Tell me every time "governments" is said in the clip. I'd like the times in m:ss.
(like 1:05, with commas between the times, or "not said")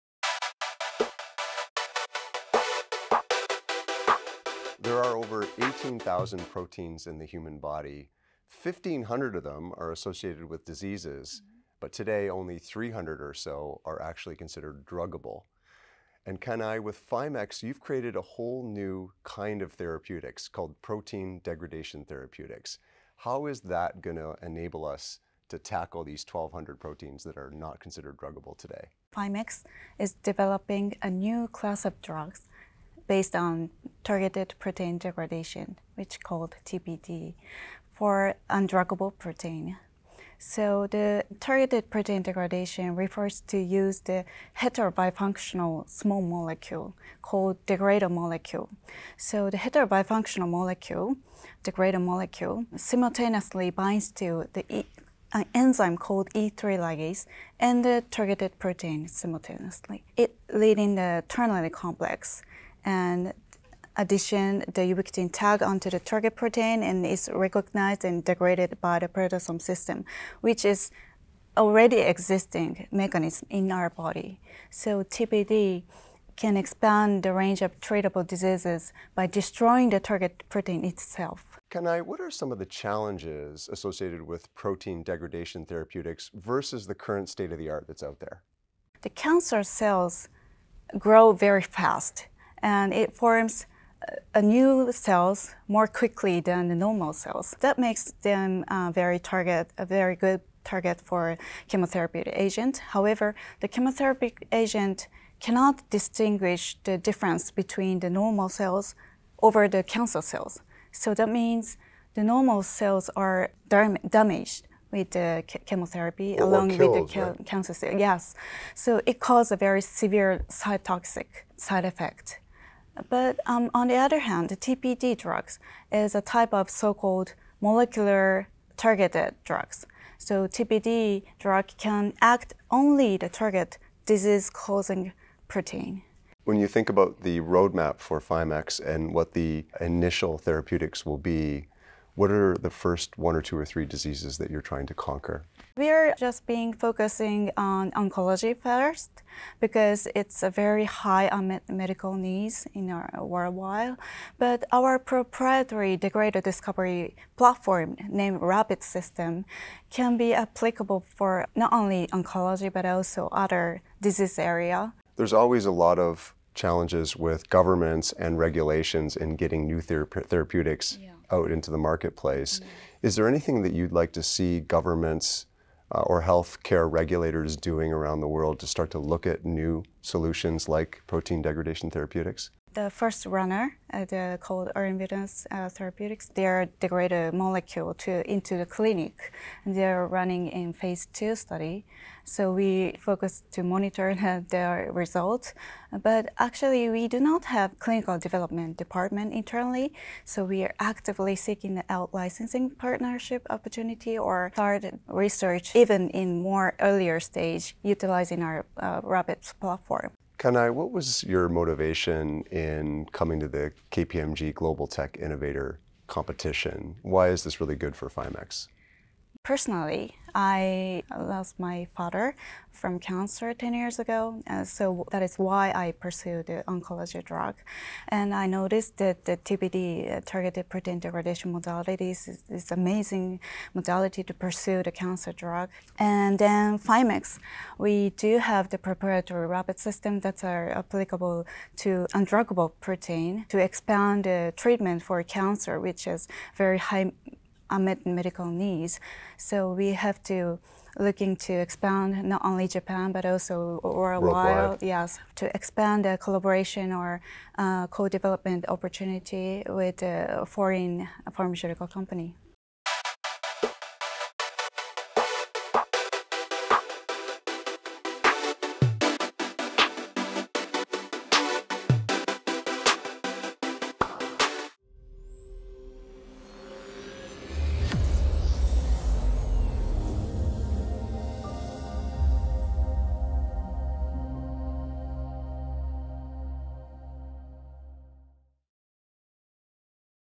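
2:47, 2:54.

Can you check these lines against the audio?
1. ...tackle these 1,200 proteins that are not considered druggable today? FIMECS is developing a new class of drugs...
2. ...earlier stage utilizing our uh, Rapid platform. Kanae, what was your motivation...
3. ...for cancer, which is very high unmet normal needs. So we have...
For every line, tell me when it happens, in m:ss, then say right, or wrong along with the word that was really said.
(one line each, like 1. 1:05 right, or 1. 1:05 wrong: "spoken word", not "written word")
1. 0:25 right
2. 3:26 wrong: "Rabbits", not "Rapid"
3. 4:05 wrong: "medical", not "normal".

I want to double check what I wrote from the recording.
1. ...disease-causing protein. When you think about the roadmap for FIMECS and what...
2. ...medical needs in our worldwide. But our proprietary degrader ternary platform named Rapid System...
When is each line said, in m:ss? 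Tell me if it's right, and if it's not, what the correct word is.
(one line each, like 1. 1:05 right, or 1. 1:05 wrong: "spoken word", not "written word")
1. 2:14 right
2. 2:31 wrong: "discovery", not "ternary".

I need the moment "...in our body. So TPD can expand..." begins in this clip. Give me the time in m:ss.
1:13.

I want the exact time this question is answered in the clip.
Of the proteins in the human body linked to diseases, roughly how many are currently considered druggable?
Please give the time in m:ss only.
0:12.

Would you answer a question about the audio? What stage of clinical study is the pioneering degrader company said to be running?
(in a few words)
Phase 2.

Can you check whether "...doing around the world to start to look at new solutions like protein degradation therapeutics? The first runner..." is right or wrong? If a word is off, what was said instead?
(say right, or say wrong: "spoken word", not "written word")
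right.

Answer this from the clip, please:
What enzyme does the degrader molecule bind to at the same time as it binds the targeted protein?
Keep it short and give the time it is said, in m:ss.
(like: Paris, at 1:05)
E3 ligase, at 0:56.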